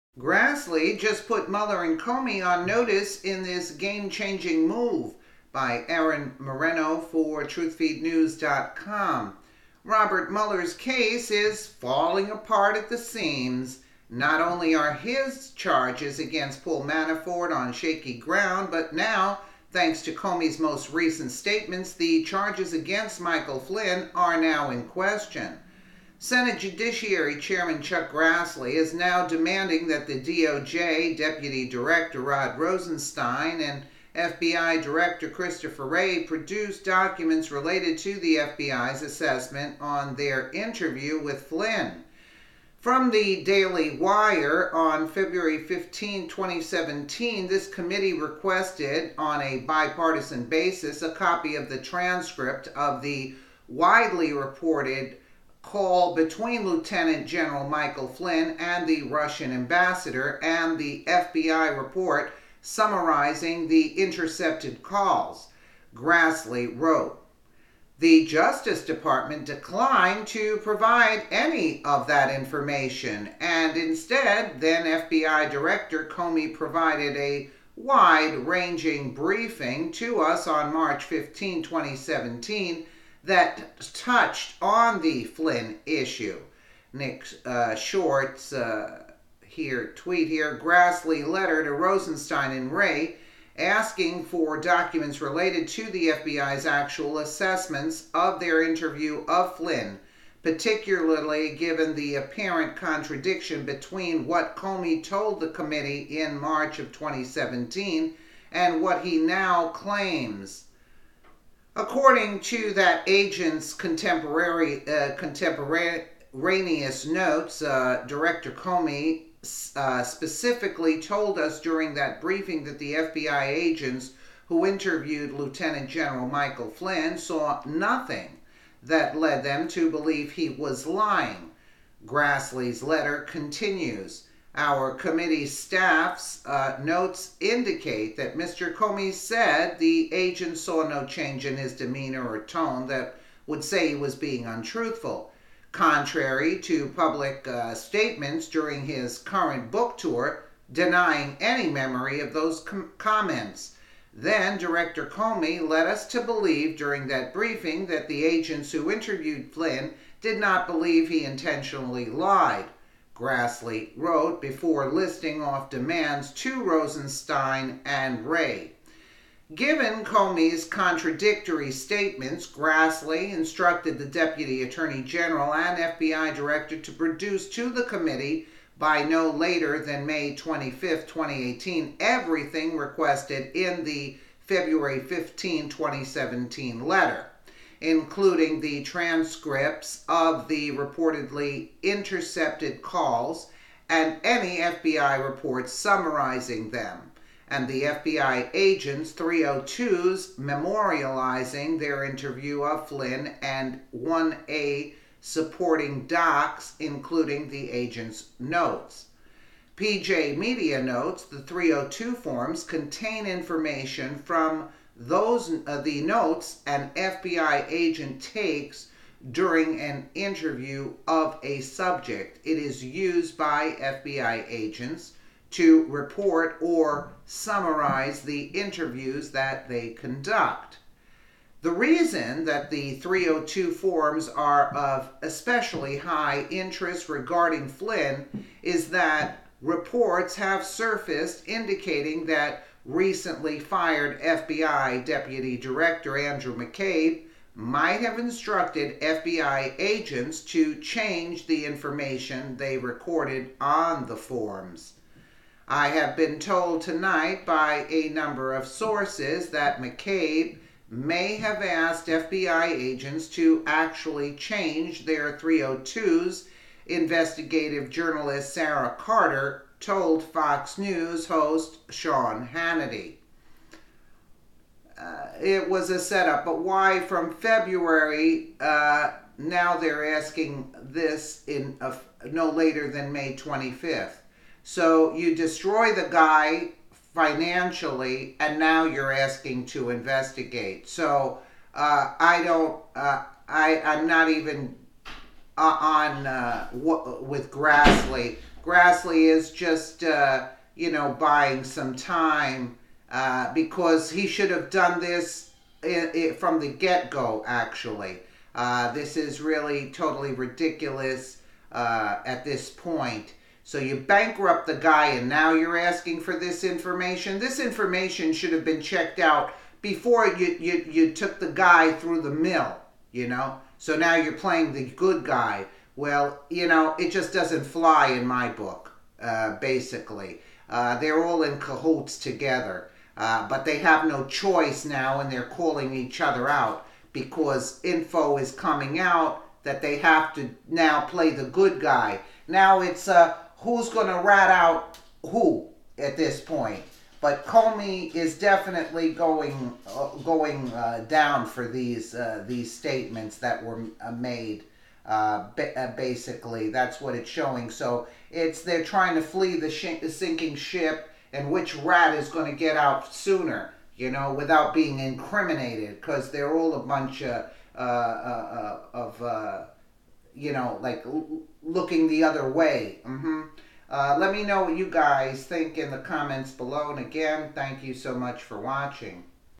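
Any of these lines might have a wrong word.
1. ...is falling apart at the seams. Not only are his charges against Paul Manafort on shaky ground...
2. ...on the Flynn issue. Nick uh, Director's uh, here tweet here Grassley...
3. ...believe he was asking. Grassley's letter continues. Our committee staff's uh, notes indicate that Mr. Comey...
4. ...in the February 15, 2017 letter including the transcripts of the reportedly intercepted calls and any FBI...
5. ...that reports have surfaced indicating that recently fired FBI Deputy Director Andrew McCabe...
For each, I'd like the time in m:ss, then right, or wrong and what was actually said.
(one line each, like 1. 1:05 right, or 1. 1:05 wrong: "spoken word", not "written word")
1. 0:11 right
2. 1:24 wrong: "Short", not "Director"
3. 2:09 wrong: "lying", not "asking"
4. 3:03 right
5. 3:58 right.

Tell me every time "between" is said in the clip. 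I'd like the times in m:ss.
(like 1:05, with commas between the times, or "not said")
0:56, 1:43.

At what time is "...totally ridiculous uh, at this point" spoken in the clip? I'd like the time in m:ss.
5:09.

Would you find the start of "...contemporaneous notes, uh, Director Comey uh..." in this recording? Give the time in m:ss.
1:55.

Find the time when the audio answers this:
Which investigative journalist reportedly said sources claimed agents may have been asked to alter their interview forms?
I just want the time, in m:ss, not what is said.
4:28.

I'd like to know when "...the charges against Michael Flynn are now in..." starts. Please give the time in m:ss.
0:21.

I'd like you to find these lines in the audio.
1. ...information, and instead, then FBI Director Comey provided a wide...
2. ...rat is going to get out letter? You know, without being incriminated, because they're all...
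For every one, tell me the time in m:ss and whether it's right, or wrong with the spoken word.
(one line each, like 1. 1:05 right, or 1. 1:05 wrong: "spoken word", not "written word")
1. 1:12 right
2. 6:01 wrong: "sooner", not "letter".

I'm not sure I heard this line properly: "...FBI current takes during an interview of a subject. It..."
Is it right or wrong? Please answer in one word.
wrong.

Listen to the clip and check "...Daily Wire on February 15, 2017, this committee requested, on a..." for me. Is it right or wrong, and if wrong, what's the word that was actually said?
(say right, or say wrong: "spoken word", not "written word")
right.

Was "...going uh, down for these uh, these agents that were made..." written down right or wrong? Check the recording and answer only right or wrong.
wrong.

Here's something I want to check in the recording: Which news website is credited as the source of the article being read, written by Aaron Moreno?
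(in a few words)
TruthFeedNews.com.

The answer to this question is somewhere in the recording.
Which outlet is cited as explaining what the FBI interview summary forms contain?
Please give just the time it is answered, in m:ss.
3:29.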